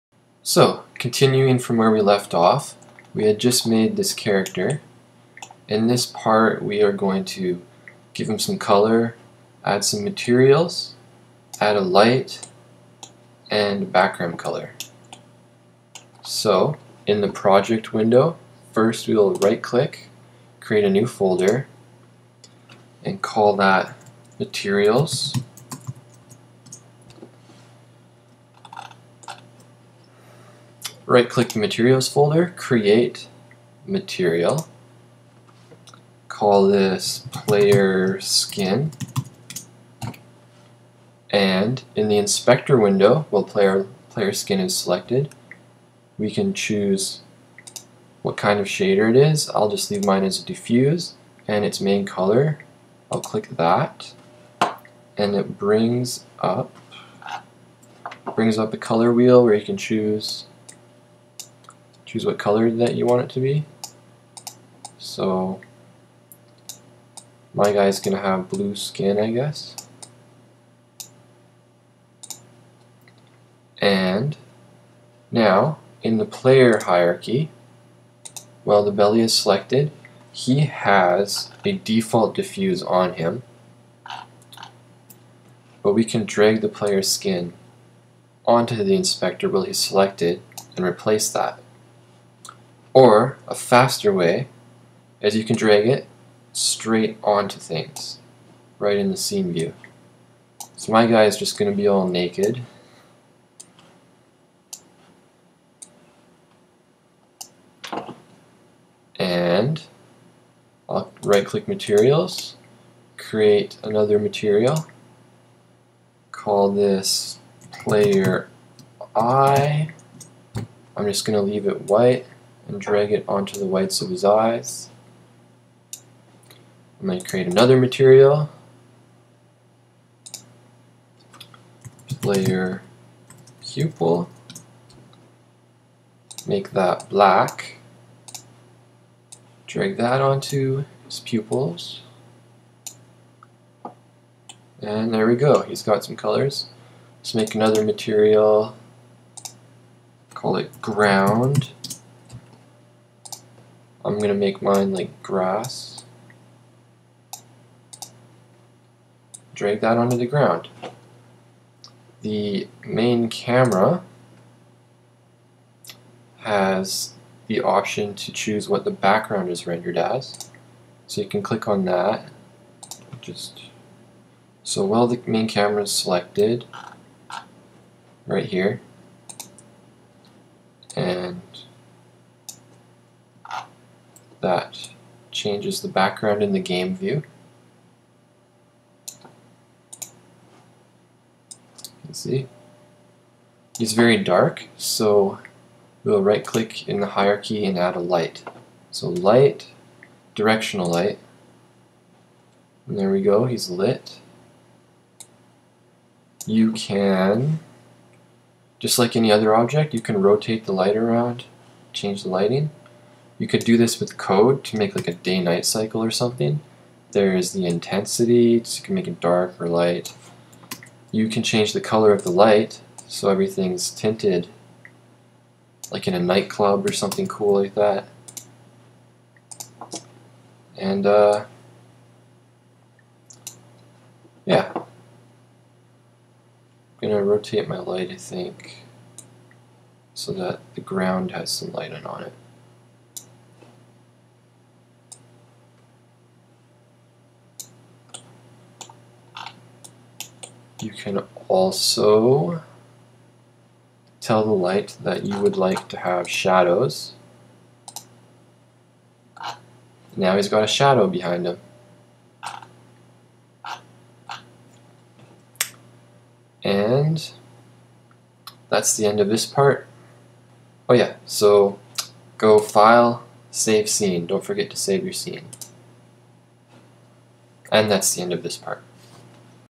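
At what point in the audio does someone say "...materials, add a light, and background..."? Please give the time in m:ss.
0:10.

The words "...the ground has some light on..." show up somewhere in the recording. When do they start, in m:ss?
4:00.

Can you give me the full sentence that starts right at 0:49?
I'll just leave mine as diffuse and its main color.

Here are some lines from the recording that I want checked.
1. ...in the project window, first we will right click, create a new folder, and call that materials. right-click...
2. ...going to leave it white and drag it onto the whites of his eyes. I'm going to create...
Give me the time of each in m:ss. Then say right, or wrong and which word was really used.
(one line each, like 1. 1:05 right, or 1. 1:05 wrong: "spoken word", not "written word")
1. 0:17 right
2. 2:01 right.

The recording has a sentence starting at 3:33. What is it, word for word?
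You could do this with code to make like a day-night cycle or something.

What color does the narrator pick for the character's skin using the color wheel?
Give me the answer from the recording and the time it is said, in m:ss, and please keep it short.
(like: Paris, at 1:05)
blue, at 1:08.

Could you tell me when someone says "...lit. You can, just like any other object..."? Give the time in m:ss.
3:23.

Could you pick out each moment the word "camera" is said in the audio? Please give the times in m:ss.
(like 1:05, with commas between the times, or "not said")
2:43, 2:55.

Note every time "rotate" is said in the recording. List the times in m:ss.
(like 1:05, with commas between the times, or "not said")
3:30, 3:57.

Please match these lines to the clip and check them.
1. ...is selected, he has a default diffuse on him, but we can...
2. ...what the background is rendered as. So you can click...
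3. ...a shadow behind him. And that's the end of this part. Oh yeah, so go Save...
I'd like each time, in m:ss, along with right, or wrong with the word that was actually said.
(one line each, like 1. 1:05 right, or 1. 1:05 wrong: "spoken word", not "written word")
1. 1:19 right
2. 2:48 right
3. 4:20 wrong: "File", not "Save".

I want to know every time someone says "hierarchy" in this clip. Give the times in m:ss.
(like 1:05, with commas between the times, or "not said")
1:16, 3:17.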